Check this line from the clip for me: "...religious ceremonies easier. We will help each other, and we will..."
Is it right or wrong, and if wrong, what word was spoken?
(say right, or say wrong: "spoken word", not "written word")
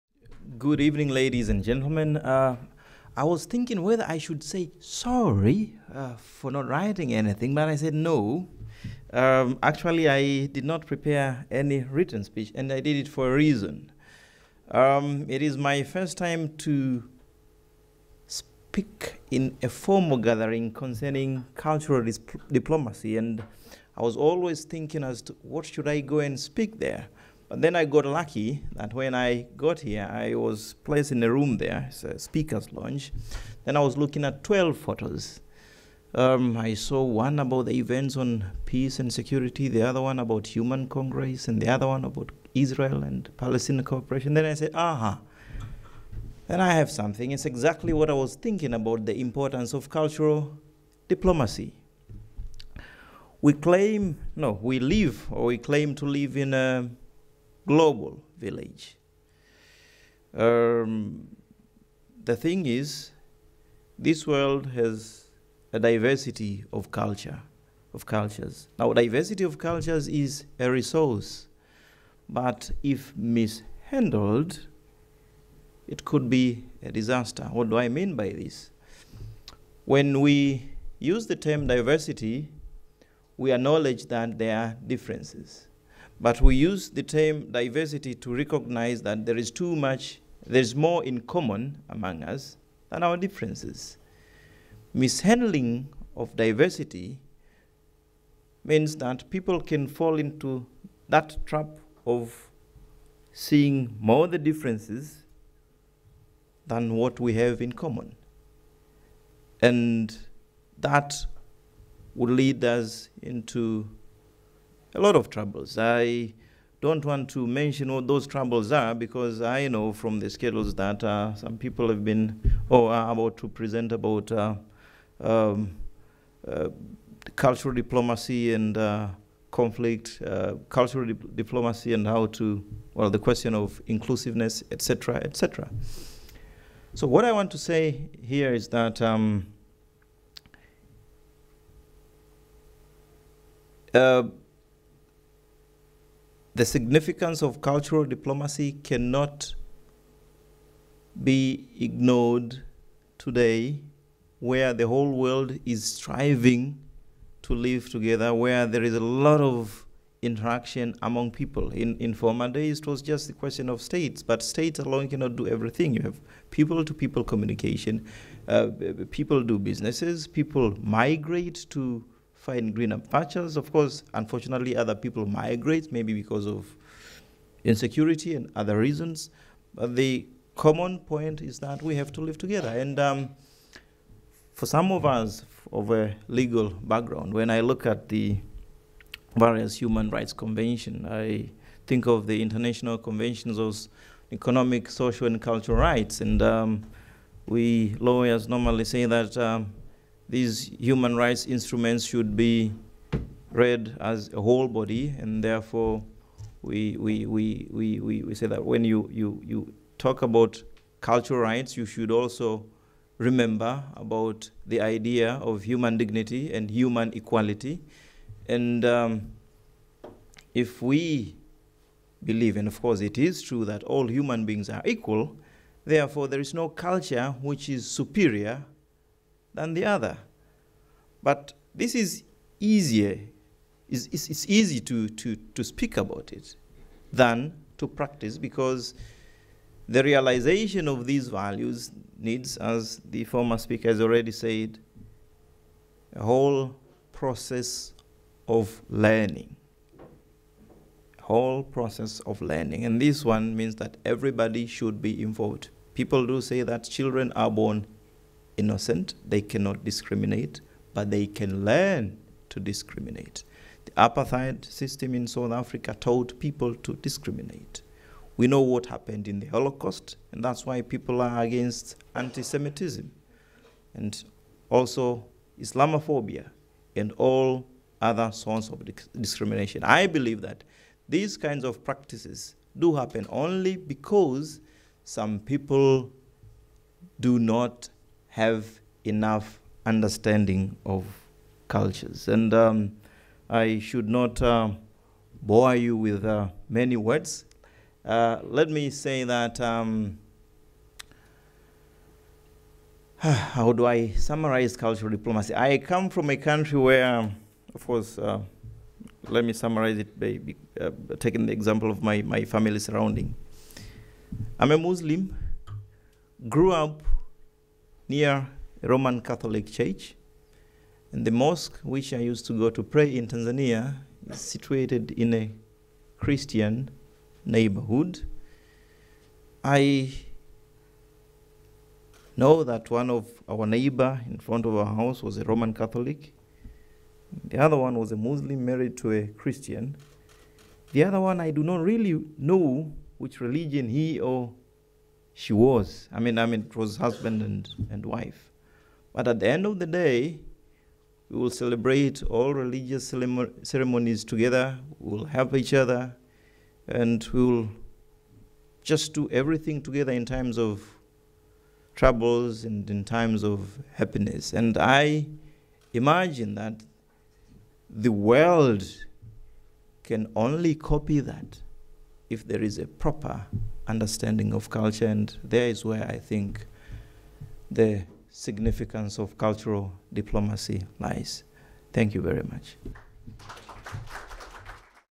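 wrong: "together", not "easier".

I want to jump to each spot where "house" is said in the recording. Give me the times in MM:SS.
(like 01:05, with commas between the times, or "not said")
05:35.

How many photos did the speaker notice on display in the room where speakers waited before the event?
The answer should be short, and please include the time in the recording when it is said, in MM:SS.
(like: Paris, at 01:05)
12, at 00:34.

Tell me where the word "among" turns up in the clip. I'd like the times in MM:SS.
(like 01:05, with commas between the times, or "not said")
01:31, 02:41.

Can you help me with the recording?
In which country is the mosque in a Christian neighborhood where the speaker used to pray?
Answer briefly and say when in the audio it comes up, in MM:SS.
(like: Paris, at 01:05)
Tanzania, at 05:23.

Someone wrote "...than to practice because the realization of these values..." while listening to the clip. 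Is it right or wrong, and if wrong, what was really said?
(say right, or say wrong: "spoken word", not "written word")
right.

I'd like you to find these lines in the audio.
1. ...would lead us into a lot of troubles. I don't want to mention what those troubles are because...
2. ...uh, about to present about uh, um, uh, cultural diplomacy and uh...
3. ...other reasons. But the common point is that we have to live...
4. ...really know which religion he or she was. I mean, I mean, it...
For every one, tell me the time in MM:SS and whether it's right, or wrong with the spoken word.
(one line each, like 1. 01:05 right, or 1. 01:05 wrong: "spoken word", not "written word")
1. 01:52 right
2. 02:03 right
3. 02:58 right
4. 05:41 right.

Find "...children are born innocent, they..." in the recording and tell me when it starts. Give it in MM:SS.
04:16.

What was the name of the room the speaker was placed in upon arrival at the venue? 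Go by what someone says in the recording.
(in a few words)
speaker's lounge.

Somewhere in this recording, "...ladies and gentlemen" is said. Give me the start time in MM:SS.
00:01.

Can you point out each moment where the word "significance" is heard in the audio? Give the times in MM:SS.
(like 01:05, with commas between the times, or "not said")
02:26, 06:18.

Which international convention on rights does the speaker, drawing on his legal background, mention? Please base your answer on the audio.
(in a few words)
economic, social, and cultural rights.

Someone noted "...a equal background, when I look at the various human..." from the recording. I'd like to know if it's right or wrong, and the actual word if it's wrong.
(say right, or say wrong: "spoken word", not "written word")
wrong: "legal", not "equal".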